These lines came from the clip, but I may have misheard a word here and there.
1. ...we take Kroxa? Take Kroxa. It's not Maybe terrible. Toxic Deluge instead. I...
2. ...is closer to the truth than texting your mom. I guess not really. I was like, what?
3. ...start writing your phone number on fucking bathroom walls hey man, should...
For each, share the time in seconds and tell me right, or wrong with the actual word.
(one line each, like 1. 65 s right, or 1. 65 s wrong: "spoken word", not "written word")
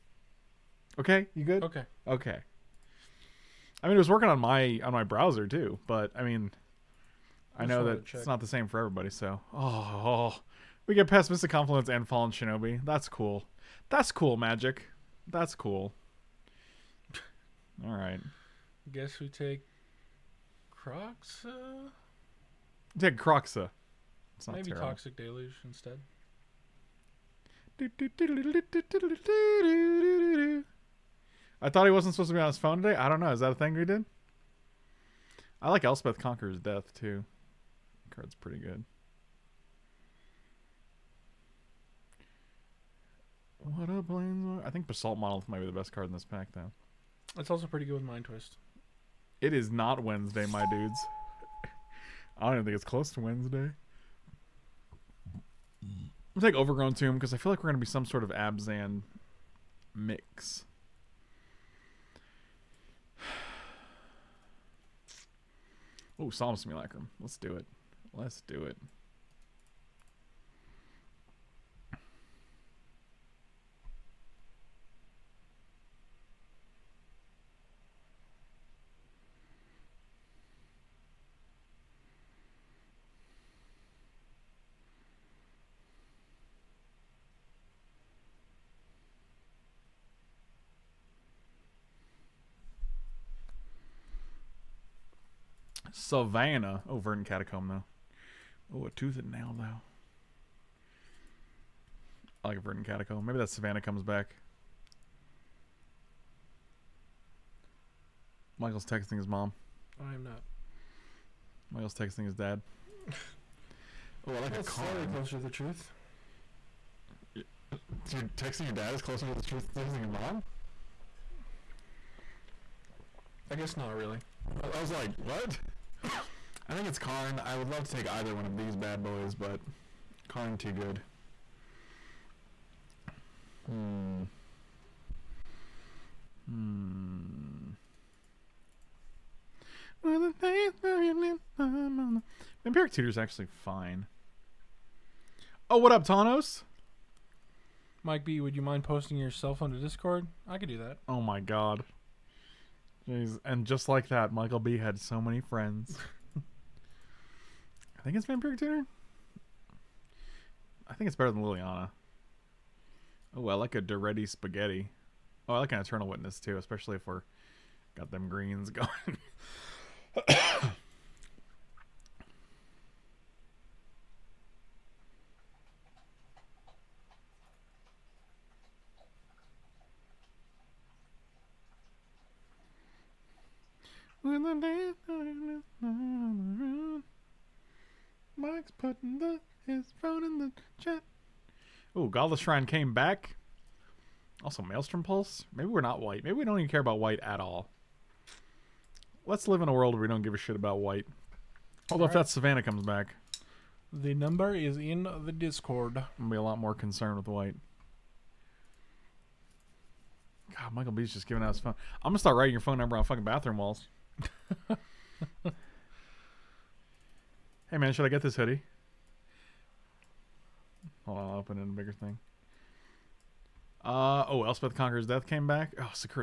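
1. 19 s right
2. 118 s right
3. 212 s right.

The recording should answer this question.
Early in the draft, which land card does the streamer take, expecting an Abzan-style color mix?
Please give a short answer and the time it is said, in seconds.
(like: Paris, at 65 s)
Overgrown Tomb, at 56 s.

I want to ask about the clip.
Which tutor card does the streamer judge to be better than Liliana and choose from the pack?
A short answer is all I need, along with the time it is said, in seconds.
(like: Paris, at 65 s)
Vampiric Tutor, at 158 s.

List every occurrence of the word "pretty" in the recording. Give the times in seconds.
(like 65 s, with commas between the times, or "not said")
38 s, 47 s.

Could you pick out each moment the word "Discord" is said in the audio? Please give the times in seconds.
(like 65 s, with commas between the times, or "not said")
149 s, 205 s.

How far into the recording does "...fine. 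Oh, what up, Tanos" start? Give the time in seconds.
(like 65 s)
143 s.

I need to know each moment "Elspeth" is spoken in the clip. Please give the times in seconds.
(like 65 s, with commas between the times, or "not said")
35 s, 224 s.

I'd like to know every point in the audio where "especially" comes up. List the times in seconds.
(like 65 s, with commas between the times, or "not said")
166 s.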